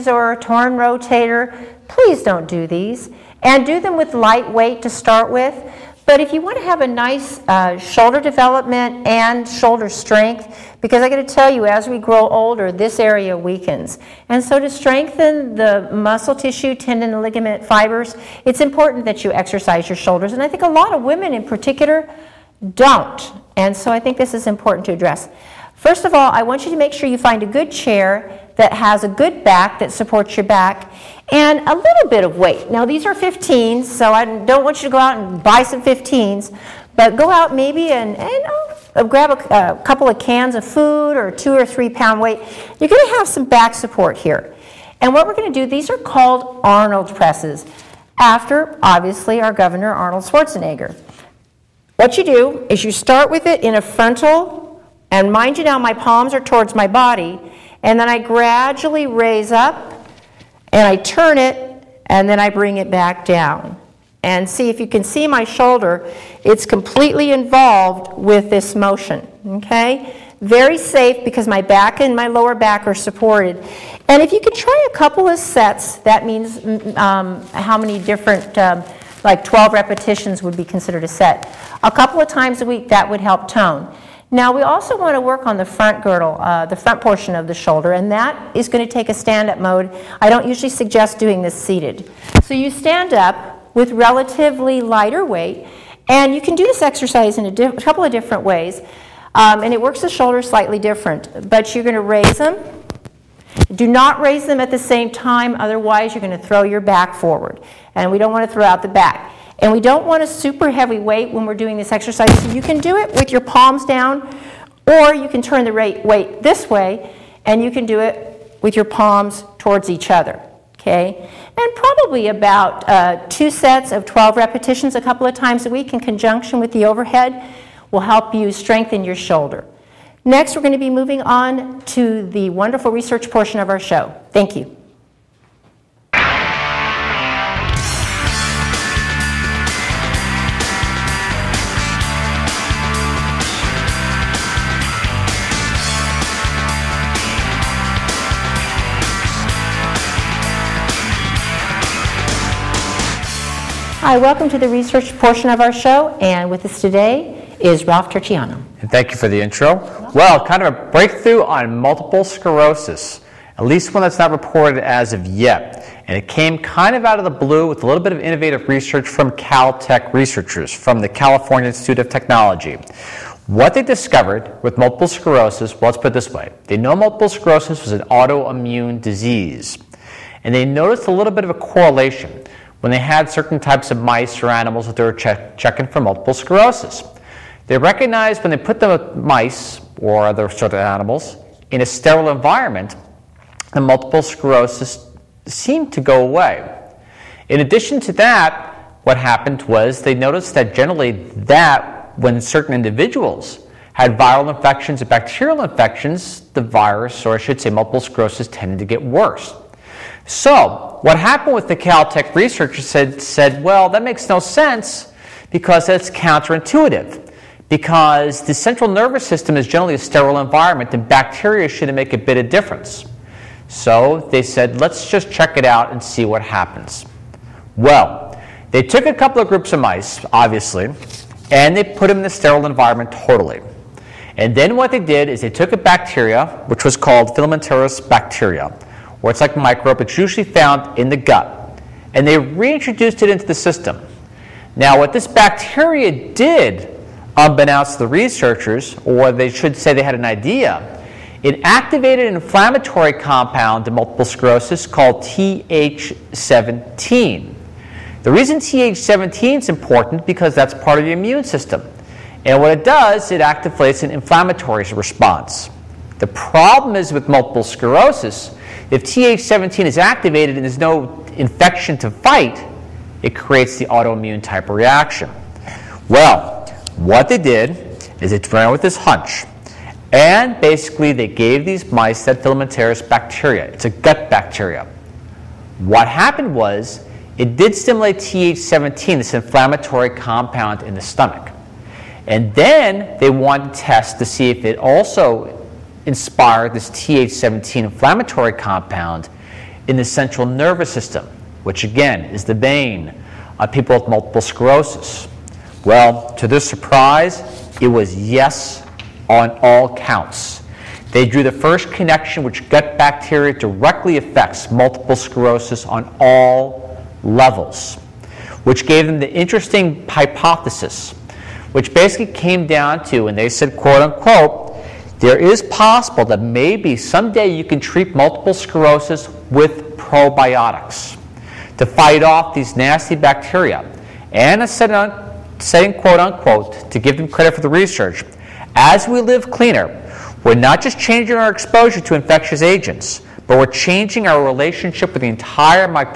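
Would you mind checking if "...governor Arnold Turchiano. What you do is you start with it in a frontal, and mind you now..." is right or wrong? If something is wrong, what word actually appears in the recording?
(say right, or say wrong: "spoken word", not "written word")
wrong: "Schwarzenegger", not "Turchiano".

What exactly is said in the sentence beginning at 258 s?
The reason TH17 is important because that's part of your immune system.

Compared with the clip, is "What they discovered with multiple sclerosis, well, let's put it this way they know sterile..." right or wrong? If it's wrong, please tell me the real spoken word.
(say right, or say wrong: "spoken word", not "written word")
wrong: "multiple", not "sterile".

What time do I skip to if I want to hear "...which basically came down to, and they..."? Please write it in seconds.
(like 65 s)
321 s.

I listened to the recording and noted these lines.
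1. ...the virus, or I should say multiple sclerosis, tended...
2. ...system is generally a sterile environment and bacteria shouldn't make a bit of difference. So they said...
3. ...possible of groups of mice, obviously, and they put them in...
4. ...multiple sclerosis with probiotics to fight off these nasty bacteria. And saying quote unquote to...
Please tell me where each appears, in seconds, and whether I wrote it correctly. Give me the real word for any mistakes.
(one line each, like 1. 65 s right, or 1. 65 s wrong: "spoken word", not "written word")
1. 206 s right
2. 219 s right
3. 229 s wrong: "couple", not "possible"
4. 328 s right.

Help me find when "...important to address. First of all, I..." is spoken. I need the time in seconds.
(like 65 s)
24 s.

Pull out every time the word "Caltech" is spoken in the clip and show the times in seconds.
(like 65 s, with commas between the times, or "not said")
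169 s, 211 s.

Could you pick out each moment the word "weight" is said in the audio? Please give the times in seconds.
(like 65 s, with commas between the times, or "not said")
4 s, 32 s, 42 s, 95 s, 110 s, 115 s.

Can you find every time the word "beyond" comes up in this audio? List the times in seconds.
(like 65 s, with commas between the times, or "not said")
not said.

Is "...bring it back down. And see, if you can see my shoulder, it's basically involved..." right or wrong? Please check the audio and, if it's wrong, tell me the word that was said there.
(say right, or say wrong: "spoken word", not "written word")
wrong: "completely", not "basically".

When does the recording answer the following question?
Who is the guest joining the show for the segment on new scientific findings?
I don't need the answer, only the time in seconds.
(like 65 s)
157 s.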